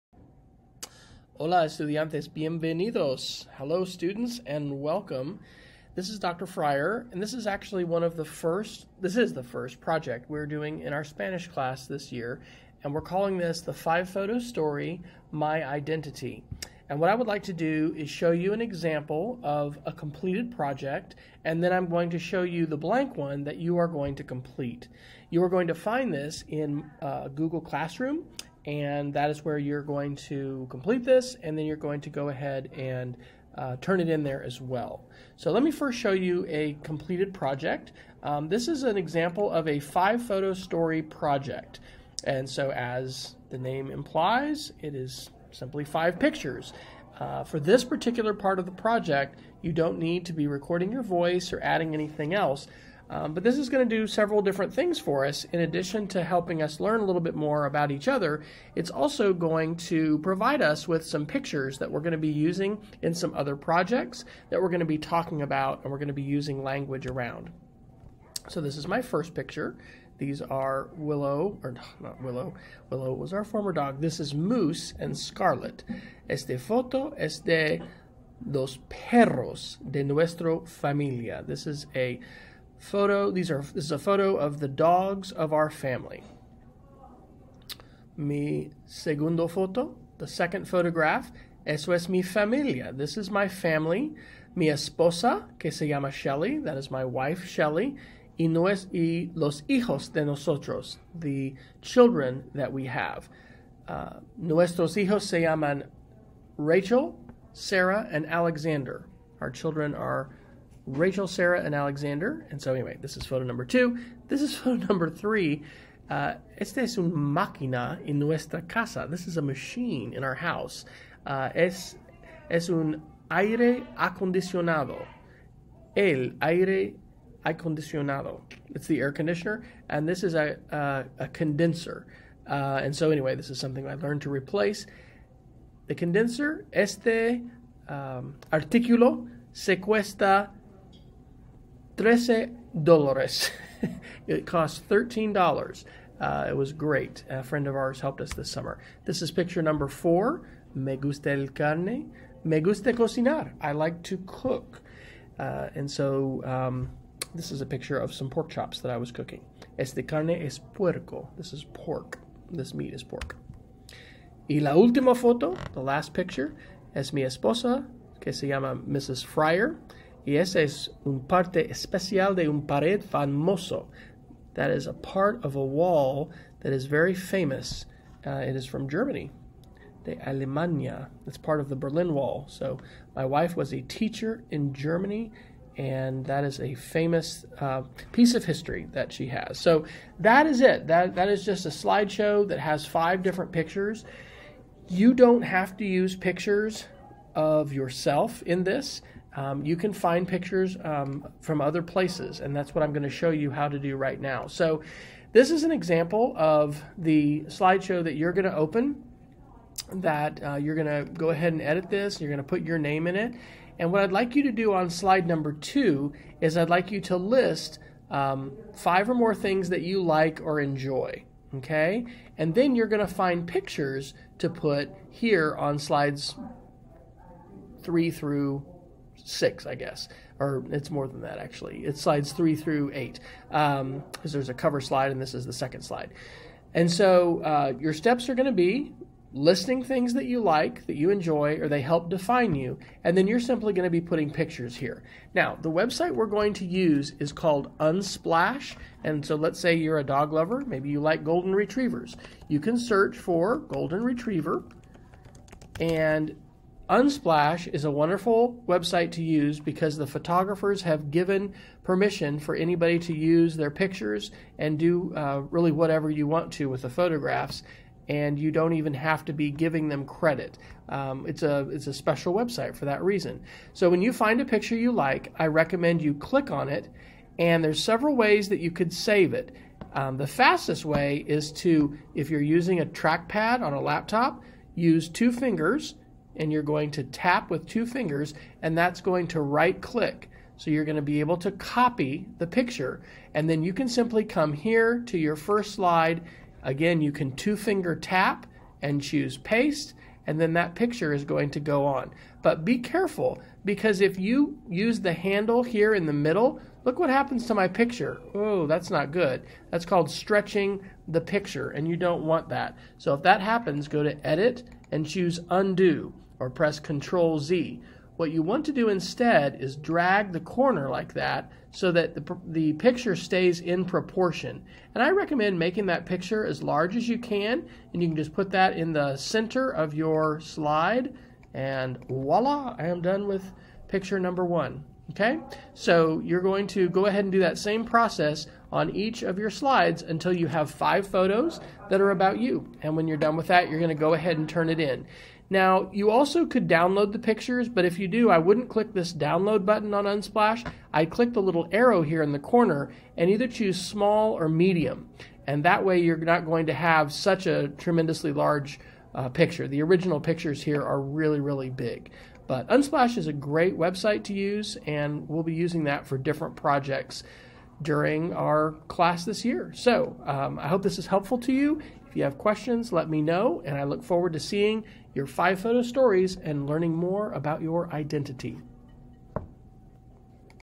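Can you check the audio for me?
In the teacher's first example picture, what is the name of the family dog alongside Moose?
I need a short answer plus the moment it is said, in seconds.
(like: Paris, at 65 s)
Scarlet, at 75 s.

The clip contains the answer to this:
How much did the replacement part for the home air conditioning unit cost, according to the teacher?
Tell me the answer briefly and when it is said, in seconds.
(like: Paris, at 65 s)
$13, at 142 s.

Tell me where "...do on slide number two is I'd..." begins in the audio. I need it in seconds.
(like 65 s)
214 s.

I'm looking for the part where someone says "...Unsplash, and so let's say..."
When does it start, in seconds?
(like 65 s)
247 s.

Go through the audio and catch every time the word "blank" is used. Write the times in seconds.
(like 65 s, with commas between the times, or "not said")
22 s.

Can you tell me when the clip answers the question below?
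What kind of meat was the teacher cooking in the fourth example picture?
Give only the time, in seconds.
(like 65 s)
158 s.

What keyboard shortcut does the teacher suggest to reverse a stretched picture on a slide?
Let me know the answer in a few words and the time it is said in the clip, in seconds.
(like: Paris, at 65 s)
Control Z, at 316 s.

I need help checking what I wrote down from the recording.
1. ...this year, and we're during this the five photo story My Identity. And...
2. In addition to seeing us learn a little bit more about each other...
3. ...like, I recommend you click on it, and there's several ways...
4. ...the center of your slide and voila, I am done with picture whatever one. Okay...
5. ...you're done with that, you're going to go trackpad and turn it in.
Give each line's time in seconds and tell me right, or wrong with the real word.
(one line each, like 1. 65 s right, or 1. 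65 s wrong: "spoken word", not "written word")
1. 11 s wrong: "calling", not "during"
2. 55 s wrong: "helping", not "seeing"
3. 274 s right
4. 328 s wrong: "number", not "whatever"
5. 343 s wrong: "ahead", not "trackpad".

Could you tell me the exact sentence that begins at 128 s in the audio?
It's the air conditioner, and this is a, uh, a condenser.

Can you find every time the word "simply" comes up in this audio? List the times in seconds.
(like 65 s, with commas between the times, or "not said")
45 s, 243 s, 293 s.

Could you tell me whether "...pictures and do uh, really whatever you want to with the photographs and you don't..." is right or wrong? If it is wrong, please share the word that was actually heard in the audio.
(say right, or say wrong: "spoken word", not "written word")
right.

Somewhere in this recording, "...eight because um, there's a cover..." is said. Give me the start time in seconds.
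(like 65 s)
232 s.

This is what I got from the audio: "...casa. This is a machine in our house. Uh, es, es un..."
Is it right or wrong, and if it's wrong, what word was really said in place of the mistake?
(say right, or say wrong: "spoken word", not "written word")
right.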